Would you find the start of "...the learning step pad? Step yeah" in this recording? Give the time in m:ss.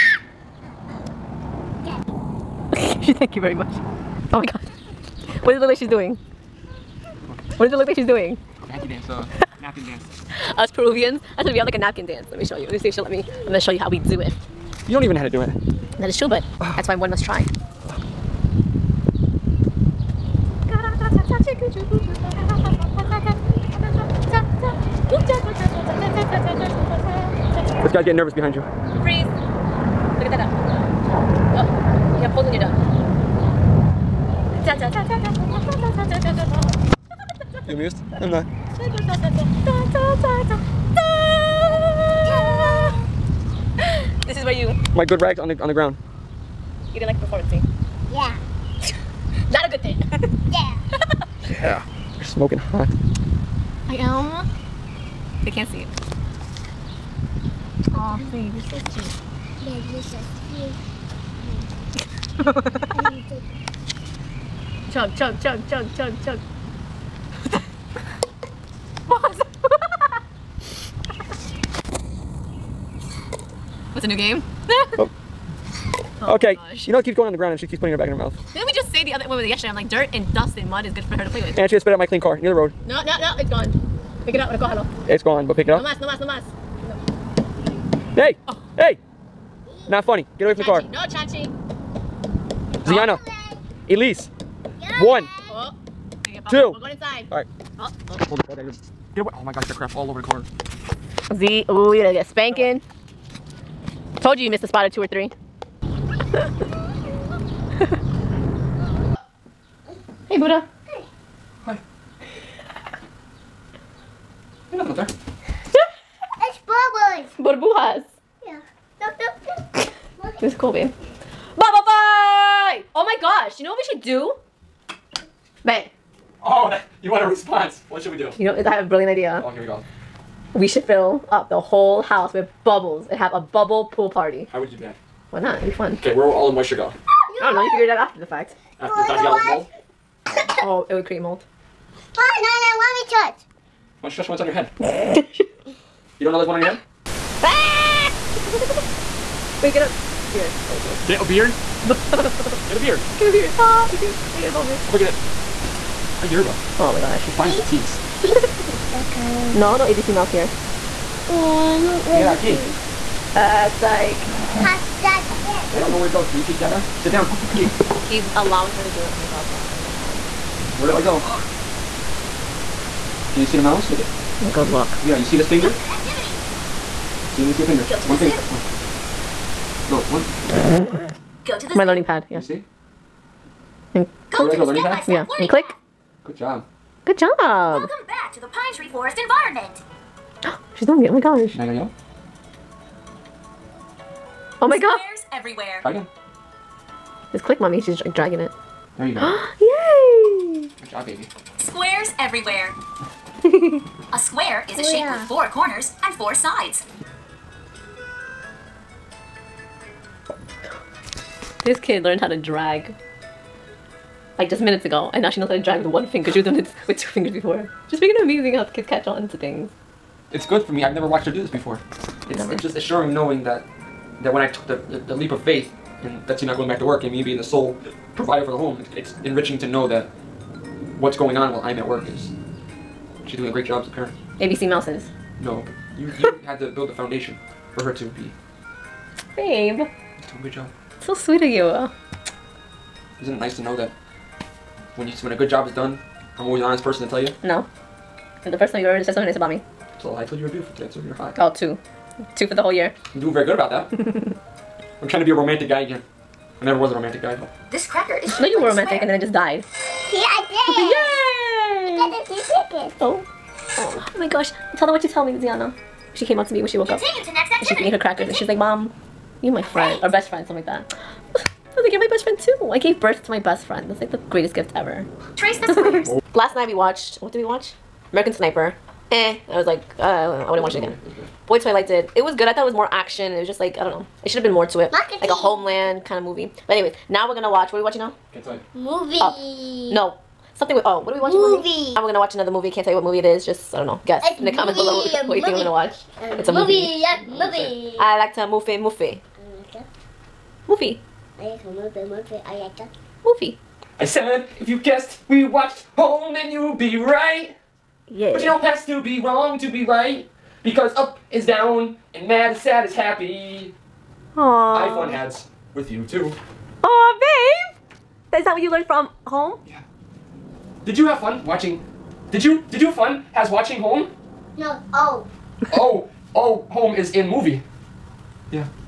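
3:04.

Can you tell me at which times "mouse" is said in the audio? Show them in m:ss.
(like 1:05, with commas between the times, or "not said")
2:40, 2:53, 3:54.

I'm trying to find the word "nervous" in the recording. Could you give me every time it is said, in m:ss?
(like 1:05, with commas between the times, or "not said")
0:28.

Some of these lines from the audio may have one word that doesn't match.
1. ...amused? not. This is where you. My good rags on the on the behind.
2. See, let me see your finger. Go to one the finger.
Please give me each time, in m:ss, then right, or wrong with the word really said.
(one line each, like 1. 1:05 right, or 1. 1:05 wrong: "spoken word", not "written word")
1. 0:37 wrong: "ground", not "behind"
2. 2:57 right.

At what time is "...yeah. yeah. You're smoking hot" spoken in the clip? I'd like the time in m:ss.
0:50.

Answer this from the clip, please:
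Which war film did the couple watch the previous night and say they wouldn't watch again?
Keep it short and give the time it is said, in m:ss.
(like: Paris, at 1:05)
American Sniper, at 4:38.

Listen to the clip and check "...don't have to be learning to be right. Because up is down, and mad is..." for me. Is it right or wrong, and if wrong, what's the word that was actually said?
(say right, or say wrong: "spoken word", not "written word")
wrong: "wrong", not "learning".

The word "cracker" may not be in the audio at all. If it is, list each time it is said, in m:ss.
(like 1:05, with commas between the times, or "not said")
4:17, 4:27.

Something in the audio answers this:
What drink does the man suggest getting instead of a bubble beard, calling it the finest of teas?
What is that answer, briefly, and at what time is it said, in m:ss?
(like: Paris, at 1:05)
yerba, at 2:36.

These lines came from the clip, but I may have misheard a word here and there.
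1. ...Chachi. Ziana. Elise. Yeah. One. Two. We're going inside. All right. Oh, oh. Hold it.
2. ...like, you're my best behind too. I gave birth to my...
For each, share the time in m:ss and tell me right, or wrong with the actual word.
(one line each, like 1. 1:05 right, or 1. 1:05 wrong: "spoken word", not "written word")
1. 1:31 right
2. 4:31 wrong: "friend", not "behind".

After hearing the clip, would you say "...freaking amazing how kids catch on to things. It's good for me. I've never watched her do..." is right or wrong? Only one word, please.
right.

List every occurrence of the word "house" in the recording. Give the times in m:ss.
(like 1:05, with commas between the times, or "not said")
2:12.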